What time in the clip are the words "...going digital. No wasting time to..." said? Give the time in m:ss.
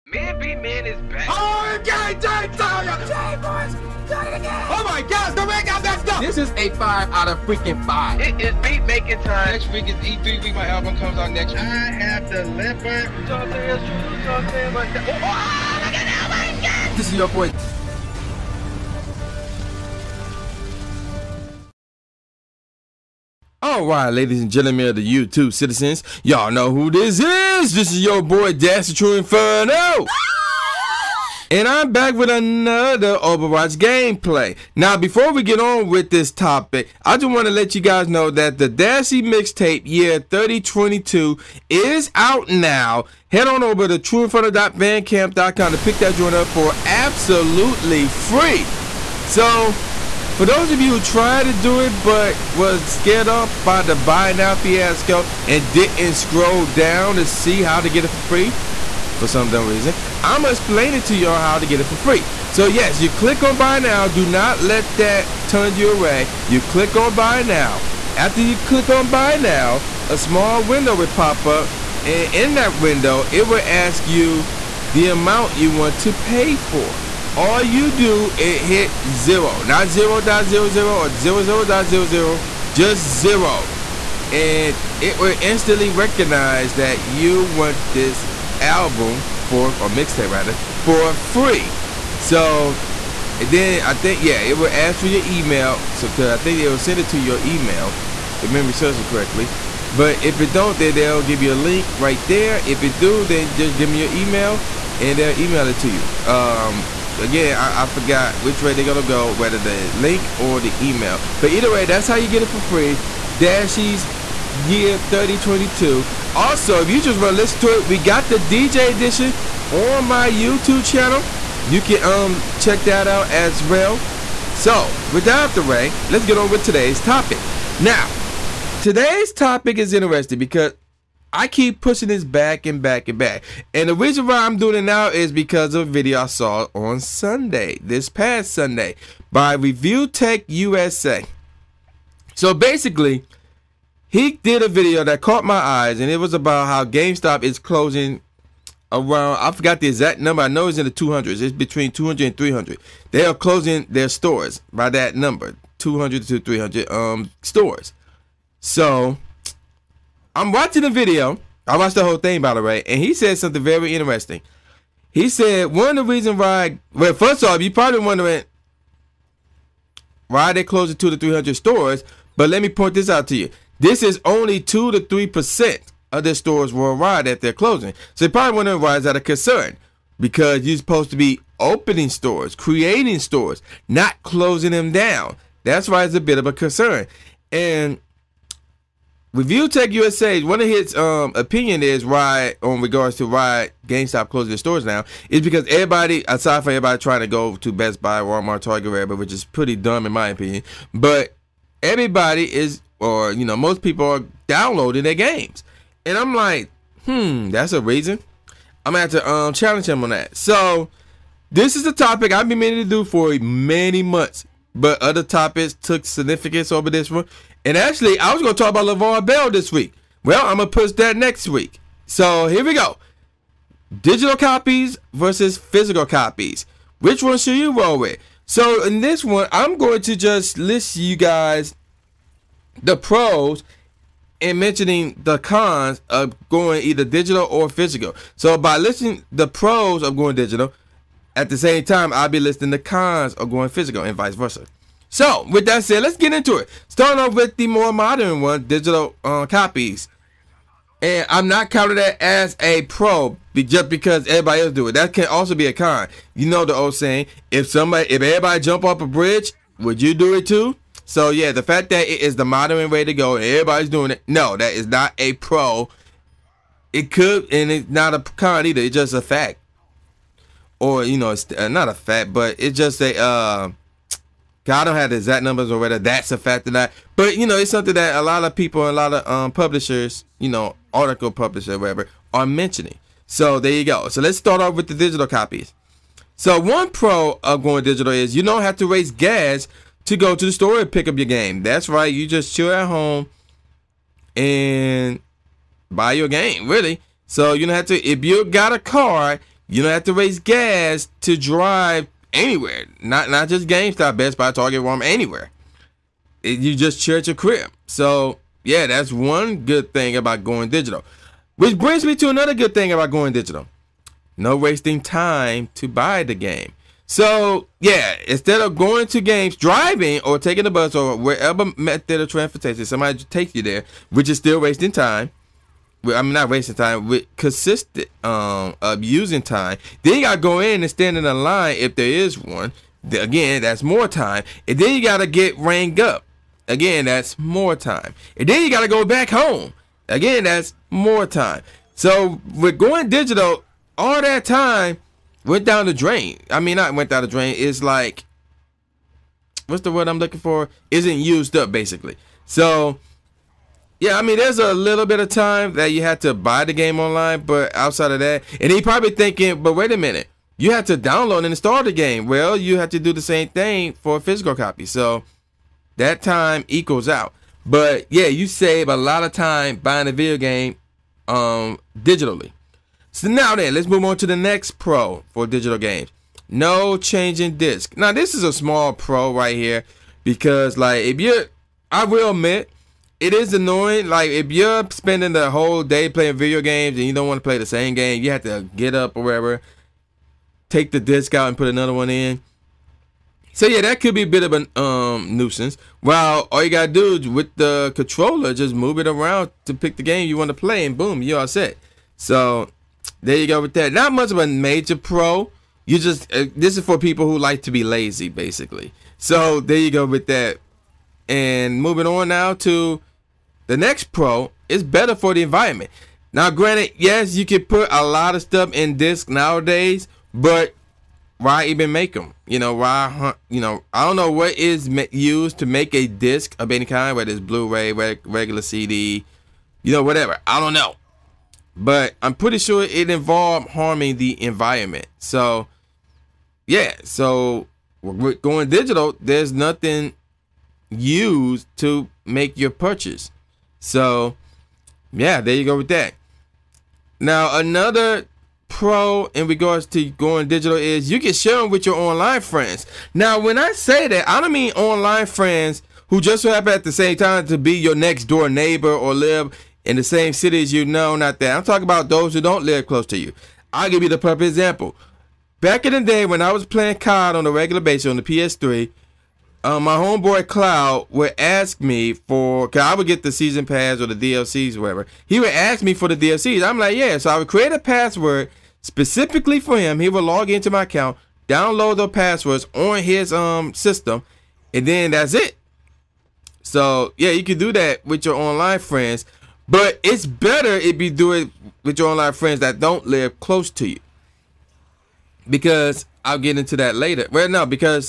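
5:13.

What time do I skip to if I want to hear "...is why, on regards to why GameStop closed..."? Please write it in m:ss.
3:11.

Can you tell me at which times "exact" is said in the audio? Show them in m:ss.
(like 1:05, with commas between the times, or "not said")
2:29, 4:35.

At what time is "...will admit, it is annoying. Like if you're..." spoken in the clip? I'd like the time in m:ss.
6:22.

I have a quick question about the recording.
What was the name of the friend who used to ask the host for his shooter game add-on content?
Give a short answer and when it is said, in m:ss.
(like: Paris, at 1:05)
Cloud, at 7:50.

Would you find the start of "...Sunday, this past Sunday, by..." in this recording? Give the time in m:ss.
2:16.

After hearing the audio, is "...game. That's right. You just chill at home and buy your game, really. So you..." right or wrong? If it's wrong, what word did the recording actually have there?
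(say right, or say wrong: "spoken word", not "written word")
right.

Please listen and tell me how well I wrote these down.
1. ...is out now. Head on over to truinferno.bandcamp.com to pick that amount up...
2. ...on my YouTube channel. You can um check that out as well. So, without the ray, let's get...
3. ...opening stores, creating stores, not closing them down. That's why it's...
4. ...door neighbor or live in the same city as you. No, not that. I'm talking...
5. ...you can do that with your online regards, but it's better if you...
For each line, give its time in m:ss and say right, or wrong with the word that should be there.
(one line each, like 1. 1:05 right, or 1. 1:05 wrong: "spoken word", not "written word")
1. 0:41 wrong: "joint", not "amount"
2. 1:59 right
3. 3:01 right
4. 7:38 right
5. 8:07 wrong: "friends", not "regards".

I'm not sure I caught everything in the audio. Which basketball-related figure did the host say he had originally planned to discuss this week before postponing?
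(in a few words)
LaVar Ball.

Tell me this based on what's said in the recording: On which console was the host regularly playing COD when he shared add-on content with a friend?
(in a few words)
PS3.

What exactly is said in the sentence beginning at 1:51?
But either way, that's how you get it for free.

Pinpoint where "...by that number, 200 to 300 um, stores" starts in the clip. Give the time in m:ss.
2:34.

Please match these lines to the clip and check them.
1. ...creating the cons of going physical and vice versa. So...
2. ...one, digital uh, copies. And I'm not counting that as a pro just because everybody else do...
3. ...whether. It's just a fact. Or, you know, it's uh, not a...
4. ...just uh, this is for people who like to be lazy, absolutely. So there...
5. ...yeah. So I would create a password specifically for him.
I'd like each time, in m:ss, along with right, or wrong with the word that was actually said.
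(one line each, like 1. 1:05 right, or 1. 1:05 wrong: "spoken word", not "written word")
1. 4:02 wrong: "listing", not "creating"
2. 4:08 right
3. 4:28 wrong: "either", not "whether"
4. 6:45 wrong: "basically", not "absolutely"
5. 7:56 right.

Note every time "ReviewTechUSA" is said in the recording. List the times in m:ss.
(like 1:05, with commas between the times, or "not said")
2:19, 3:09.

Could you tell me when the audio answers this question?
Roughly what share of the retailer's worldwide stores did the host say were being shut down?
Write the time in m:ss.
2:54.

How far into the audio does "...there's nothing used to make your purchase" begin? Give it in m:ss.
7:19.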